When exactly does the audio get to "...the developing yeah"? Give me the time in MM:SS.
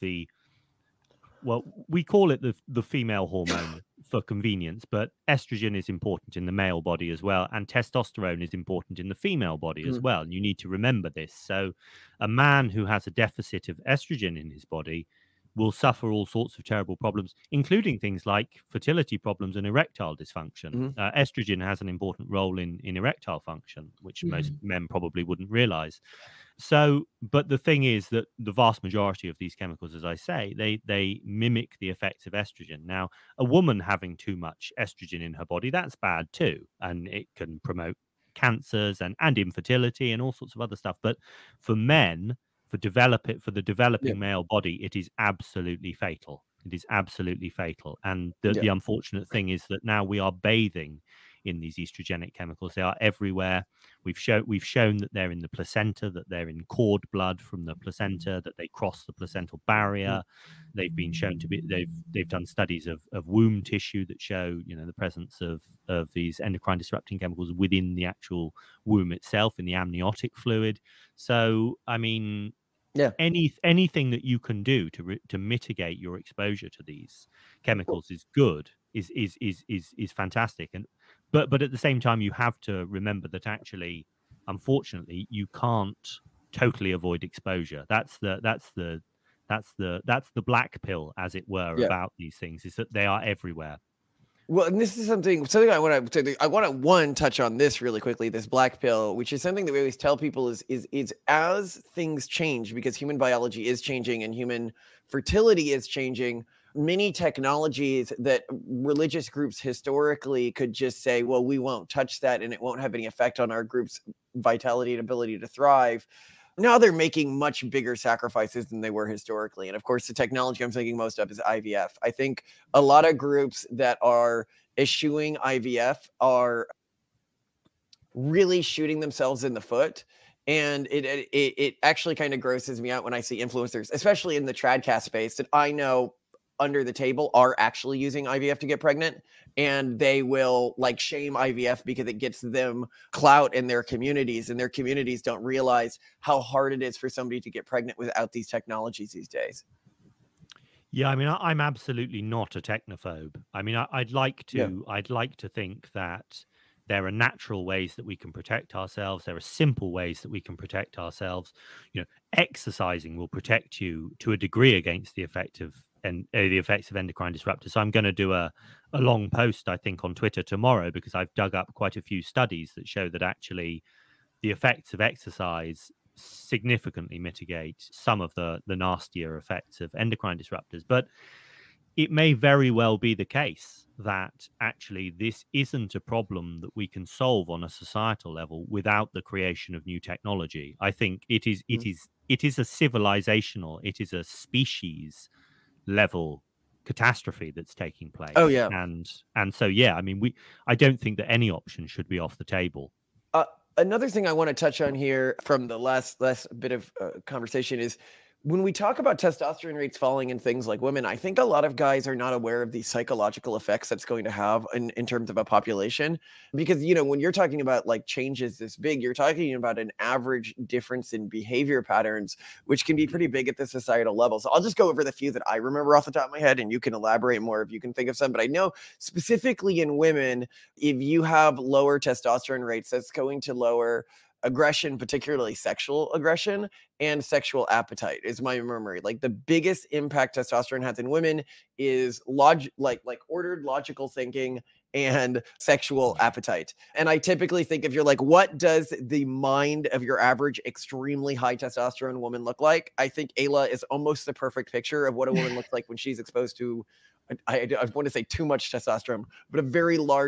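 00:43.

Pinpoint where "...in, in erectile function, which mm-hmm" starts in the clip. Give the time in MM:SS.
00:22.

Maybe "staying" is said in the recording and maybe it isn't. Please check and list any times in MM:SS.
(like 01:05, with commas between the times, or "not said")
not said.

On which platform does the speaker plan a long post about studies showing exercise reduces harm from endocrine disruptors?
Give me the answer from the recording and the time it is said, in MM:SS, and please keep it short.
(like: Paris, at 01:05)
Twitter, at 02:50.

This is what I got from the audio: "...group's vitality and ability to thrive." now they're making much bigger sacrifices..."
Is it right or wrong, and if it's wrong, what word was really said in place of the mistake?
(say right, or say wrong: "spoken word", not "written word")
right.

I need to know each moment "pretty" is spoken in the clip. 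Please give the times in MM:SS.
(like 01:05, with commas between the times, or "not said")
03:43.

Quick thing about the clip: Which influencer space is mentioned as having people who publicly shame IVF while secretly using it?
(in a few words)
Tradcast.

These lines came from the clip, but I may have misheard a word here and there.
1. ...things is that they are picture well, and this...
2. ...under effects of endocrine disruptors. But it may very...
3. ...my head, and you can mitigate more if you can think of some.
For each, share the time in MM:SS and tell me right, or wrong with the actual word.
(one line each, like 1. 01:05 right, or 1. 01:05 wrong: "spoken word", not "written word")
1. 01:32 wrong: "everywhere", not "picture"
2. 02:58 wrong: "nastier", not "under"
3. 03:46 wrong: "elaborate", not "mitigate".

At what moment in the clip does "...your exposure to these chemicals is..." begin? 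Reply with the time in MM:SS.
01:15.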